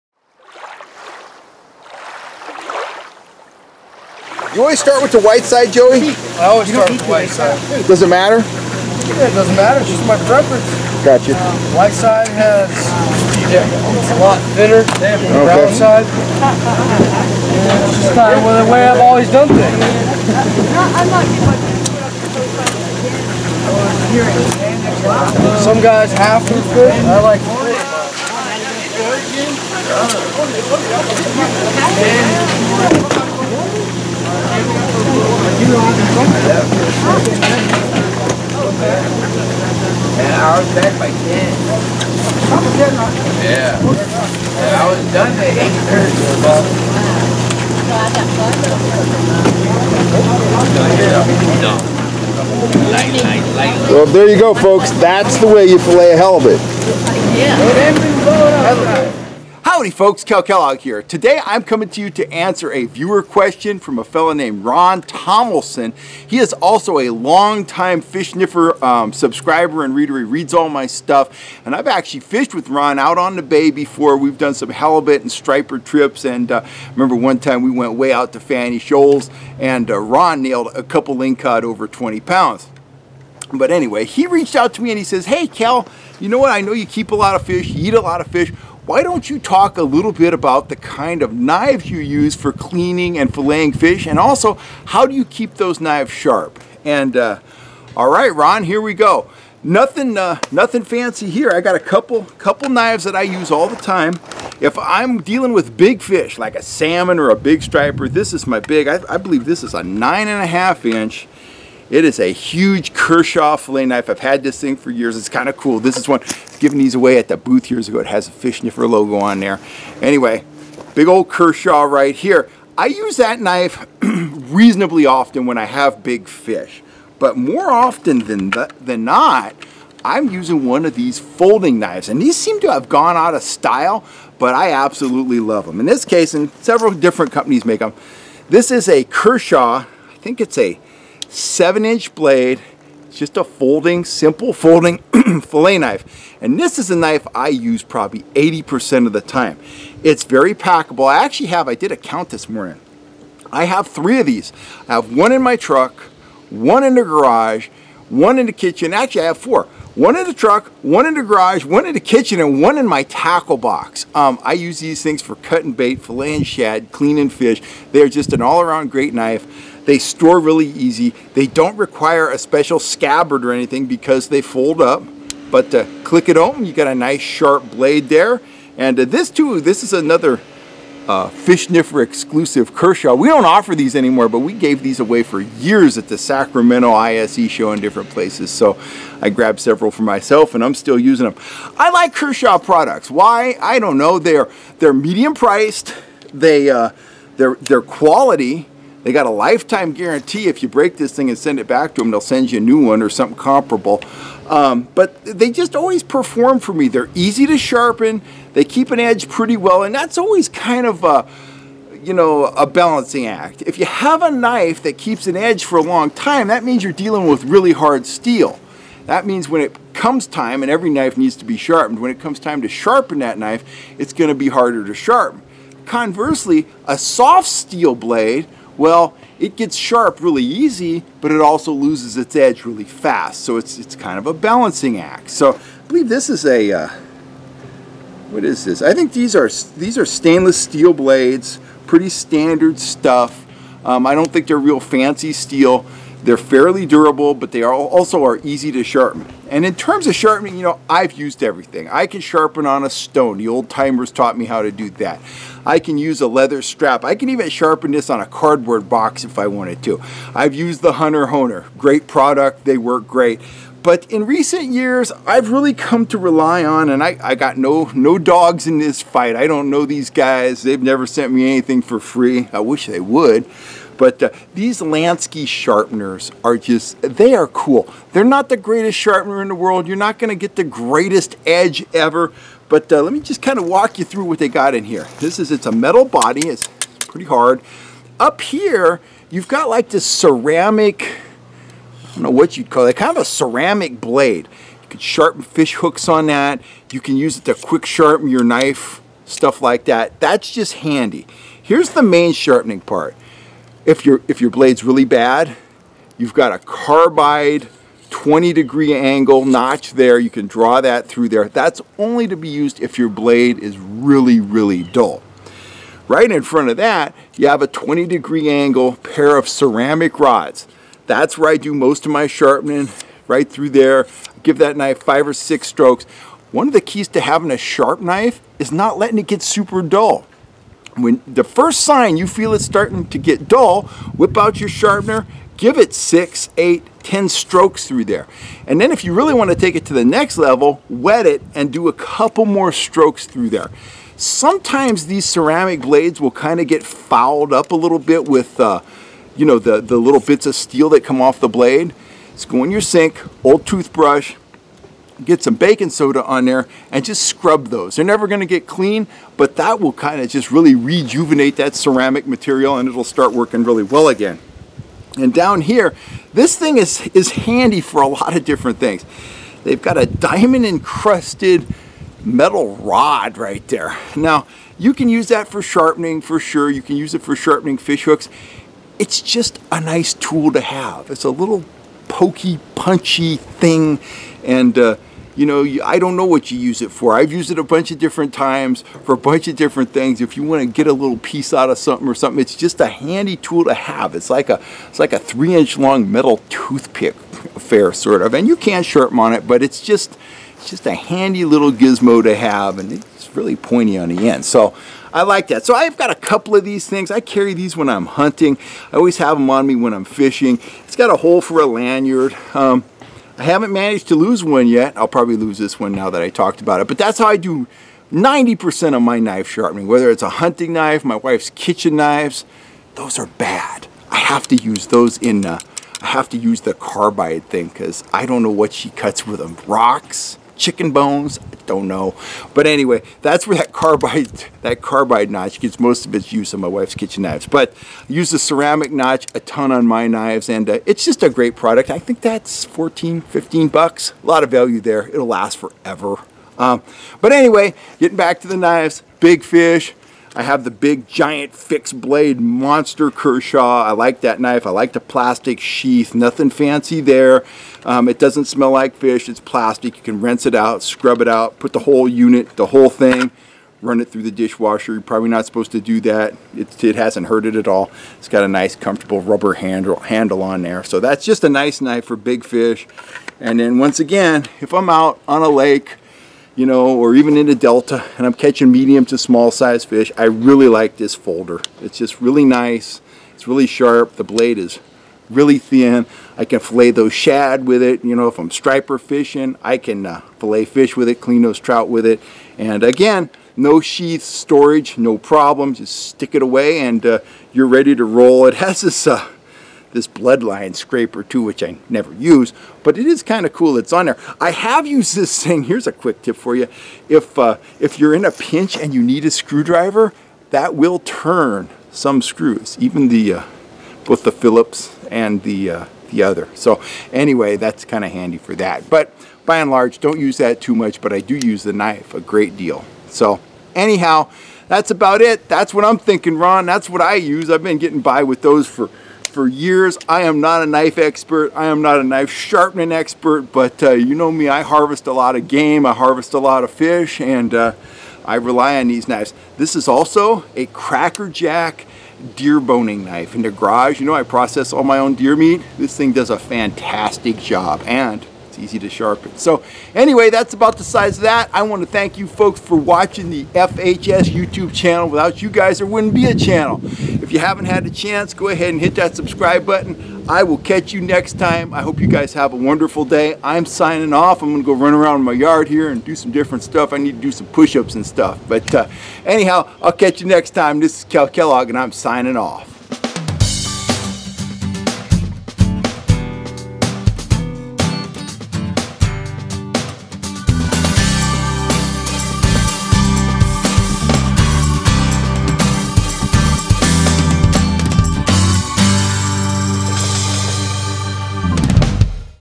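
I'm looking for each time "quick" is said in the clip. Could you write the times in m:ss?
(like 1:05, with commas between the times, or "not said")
4:57, 8:25.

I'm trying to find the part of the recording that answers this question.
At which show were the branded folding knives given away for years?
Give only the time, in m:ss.
3:06.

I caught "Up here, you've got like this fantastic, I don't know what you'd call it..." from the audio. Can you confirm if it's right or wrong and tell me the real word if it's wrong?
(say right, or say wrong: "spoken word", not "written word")
wrong: "ceramic", not "fantastic".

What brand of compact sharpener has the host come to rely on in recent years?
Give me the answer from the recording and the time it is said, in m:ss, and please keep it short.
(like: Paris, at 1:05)
Lansky, at 4:34.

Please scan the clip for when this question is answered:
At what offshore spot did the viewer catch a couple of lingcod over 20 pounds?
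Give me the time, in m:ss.
1:18.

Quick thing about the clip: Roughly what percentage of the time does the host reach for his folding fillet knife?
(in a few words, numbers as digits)
80%.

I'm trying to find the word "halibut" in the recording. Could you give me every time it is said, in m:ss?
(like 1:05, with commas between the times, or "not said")
0:56, 1:14.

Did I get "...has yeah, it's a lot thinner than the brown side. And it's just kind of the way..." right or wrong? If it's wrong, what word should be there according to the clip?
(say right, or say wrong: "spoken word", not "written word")
right.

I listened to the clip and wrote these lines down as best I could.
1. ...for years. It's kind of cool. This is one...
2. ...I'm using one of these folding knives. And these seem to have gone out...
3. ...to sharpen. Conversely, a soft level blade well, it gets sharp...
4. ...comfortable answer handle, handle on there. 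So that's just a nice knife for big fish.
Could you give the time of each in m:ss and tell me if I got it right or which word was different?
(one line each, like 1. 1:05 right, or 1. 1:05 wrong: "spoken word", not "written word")
1. 1:54 right
2. 2:10 right
3. 3:44 wrong: "steel", not "level"
4. 7:48 wrong: "rubber", not "answer".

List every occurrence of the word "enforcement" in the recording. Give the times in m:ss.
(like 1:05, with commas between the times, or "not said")
not said.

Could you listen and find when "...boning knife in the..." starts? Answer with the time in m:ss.
9:02.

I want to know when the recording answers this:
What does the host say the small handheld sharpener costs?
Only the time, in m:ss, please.
7:22.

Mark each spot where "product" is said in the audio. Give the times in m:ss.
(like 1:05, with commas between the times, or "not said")
3:12, 4:22, 7:21.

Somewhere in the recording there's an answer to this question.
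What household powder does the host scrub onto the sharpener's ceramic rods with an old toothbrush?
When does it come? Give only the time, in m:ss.
5:55.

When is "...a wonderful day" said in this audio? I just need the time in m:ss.
9:22.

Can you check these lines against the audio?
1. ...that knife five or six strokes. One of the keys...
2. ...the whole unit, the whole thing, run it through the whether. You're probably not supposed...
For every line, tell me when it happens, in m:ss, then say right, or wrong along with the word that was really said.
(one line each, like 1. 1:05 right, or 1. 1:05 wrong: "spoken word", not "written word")
1. 5:24 right
2. 7:41 wrong: "dishwasher", not "whether".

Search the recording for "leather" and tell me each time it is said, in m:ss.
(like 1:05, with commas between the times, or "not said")
4:16.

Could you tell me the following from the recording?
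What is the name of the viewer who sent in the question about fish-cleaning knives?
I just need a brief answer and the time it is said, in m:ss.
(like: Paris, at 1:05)
Ron Tomlinson, at 1:04.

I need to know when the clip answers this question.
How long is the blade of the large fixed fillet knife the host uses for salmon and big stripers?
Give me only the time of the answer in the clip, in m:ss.
1:49.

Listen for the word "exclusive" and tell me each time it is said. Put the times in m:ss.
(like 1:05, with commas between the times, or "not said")
3:02.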